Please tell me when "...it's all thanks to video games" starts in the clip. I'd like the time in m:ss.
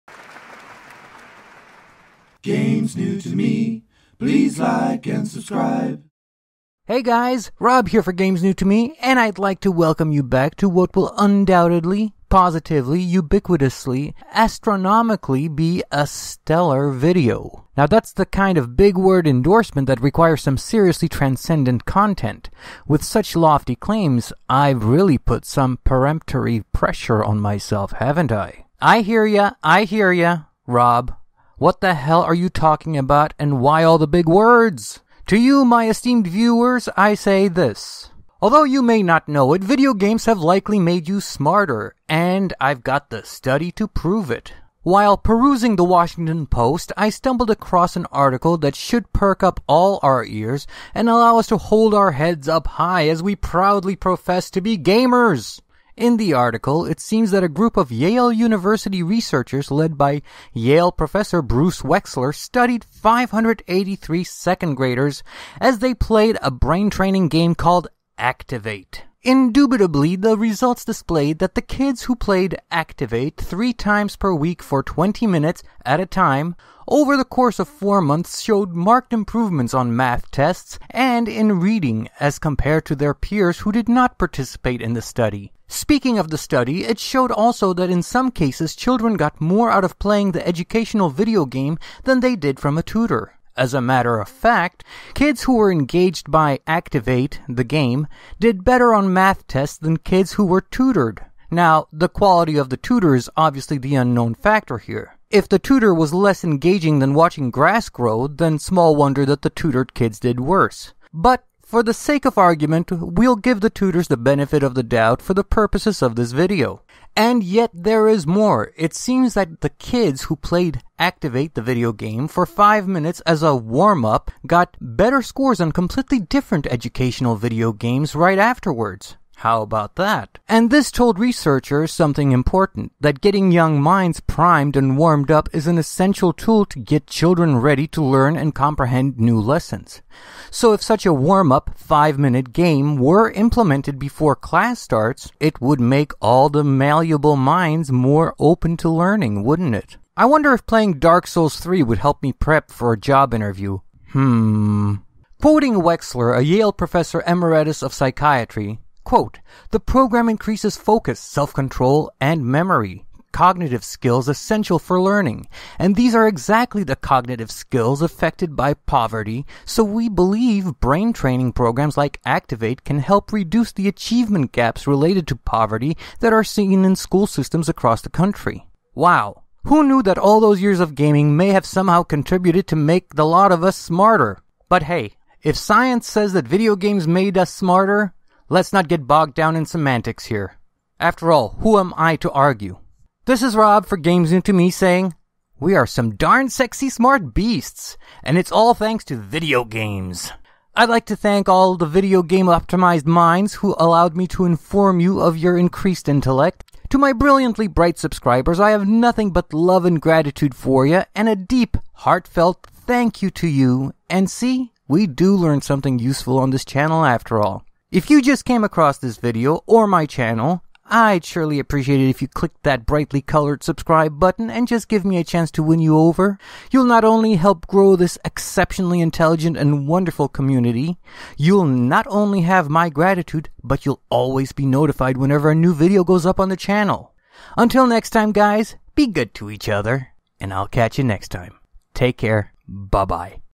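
3:18.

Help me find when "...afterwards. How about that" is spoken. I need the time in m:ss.
2:08.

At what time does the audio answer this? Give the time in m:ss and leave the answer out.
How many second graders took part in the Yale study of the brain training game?
1:02.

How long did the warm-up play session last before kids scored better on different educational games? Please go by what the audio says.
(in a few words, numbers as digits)
5 minutes.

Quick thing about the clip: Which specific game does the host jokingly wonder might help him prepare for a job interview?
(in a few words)
Dark Souls 3.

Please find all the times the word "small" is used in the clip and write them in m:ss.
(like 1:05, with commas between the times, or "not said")
1:48.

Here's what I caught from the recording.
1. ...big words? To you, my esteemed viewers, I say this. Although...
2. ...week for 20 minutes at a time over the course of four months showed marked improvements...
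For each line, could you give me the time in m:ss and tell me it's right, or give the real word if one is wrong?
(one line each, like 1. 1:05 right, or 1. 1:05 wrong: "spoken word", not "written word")
1. 0:34 right
2. 1:14 right.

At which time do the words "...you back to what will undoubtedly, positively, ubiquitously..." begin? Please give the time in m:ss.
0:10.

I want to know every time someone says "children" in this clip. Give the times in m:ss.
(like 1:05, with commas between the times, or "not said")
1:28, 2:17.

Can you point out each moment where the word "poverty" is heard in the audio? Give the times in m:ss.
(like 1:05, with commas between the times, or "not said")
2:48, 2:55.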